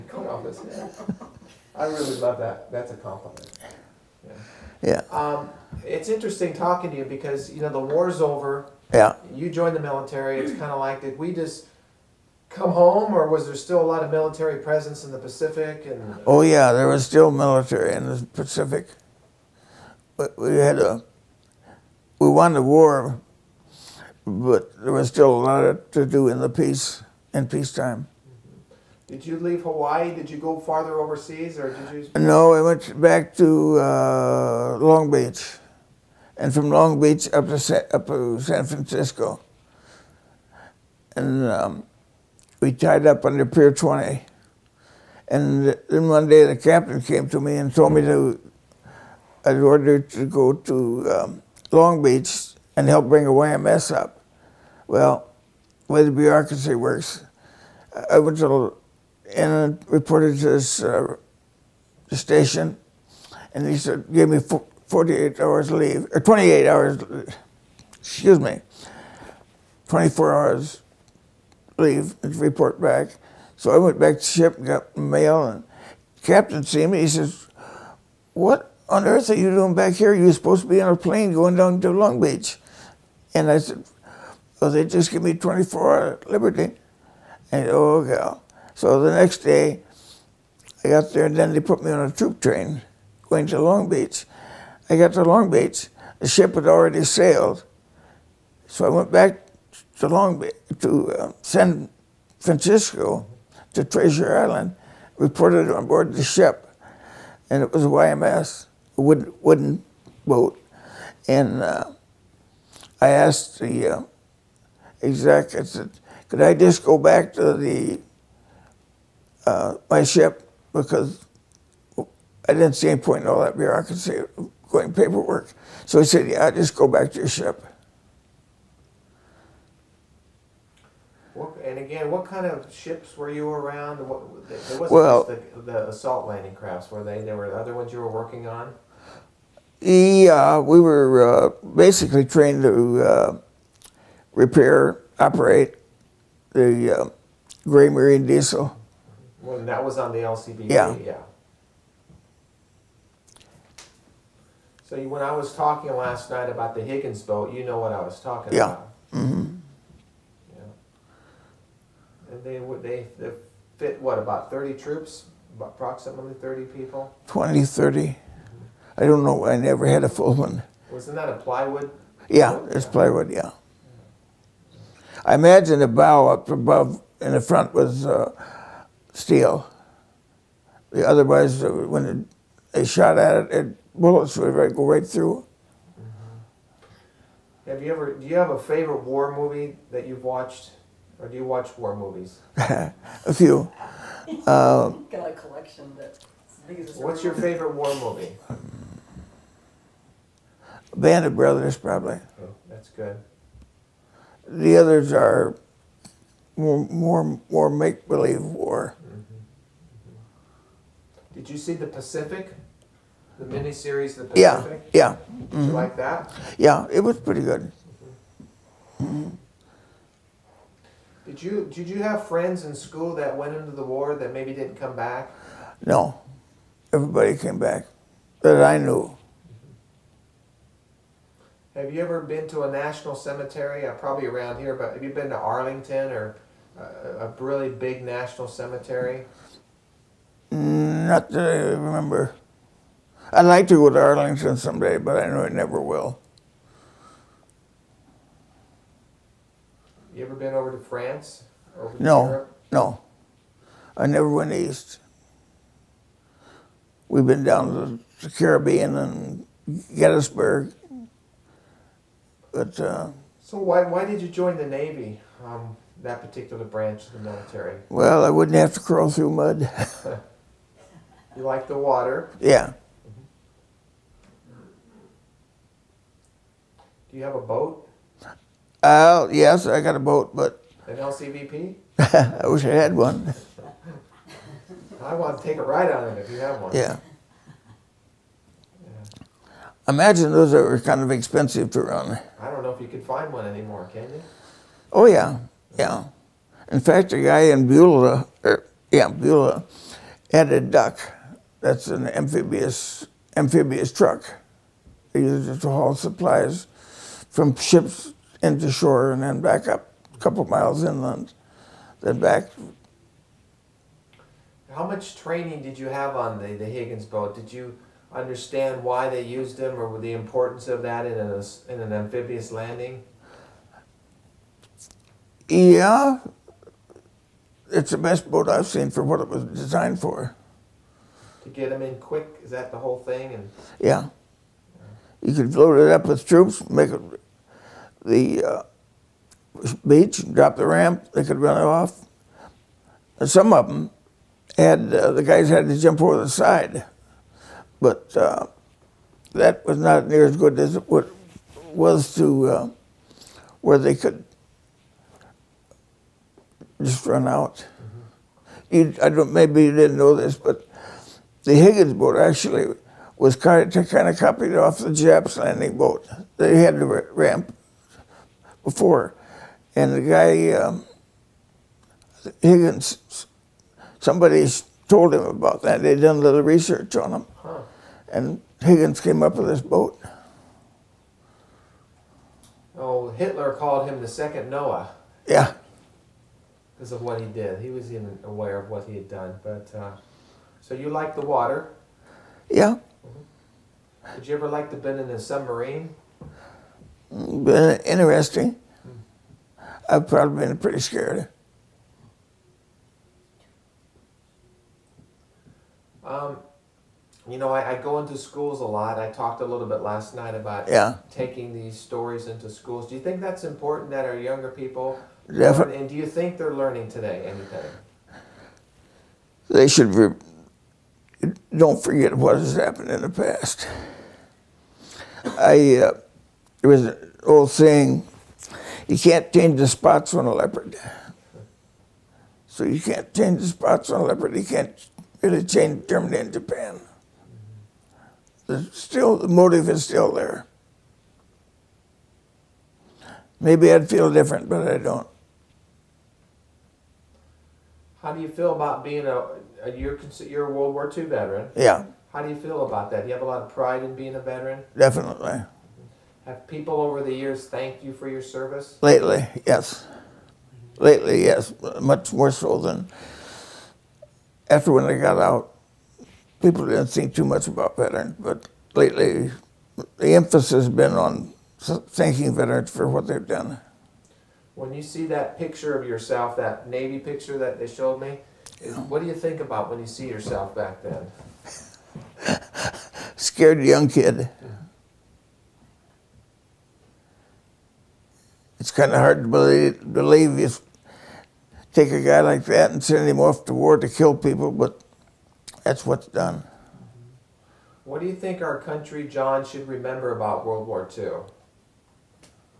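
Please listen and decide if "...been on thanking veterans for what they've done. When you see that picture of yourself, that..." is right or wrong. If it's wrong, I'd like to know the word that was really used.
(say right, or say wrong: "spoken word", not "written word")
right.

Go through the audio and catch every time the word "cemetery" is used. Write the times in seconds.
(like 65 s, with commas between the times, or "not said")
233 s, 238 s.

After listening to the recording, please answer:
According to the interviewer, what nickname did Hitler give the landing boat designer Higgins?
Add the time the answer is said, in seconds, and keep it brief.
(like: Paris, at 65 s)
the second Noah, at 384 s.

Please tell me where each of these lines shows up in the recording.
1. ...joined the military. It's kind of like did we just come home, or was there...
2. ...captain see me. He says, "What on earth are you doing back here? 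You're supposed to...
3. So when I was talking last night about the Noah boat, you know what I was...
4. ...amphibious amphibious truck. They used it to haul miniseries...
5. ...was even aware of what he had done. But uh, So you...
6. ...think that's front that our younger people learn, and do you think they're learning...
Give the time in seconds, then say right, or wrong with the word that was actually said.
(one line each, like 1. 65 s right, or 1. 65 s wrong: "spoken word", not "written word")
1. 9 s right
2. 76 s right
3. 154 s wrong: "Higgins", not "Noah"
4. 302 s wrong: "supplies", not "miniseries"
5. 387 s right
6. 413 s wrong: "important", not "front".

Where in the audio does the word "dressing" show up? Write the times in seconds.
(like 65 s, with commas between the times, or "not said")
not said.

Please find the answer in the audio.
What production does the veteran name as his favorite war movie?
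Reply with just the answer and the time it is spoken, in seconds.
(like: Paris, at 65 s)
Band of Brothers, at 200 s.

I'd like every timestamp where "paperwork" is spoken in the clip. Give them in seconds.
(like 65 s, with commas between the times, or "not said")
124 s.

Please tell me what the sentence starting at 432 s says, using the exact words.
So you can't change the spots on a leopard.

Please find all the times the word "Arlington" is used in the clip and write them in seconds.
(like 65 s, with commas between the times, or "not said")
235 s, 244 s.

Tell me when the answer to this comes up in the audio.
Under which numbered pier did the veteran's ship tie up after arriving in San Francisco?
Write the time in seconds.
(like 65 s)
43 s.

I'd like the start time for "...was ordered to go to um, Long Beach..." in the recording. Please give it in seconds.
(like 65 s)
49 s.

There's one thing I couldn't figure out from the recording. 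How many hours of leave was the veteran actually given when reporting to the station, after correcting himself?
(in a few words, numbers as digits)
24.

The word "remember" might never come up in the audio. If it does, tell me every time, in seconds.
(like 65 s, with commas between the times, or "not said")
241 s, 499 s.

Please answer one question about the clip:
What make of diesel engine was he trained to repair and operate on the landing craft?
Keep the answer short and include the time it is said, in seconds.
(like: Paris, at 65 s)
Gray Marine, at 147 s.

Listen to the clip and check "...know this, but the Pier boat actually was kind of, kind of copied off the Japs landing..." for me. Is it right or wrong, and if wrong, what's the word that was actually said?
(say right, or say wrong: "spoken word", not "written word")
wrong: "Higgins", not "Pier".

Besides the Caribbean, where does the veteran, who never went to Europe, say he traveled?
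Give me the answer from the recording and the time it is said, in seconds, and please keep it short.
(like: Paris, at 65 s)
Gettysburg, at 259 s.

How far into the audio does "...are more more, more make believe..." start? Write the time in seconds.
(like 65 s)
205 s.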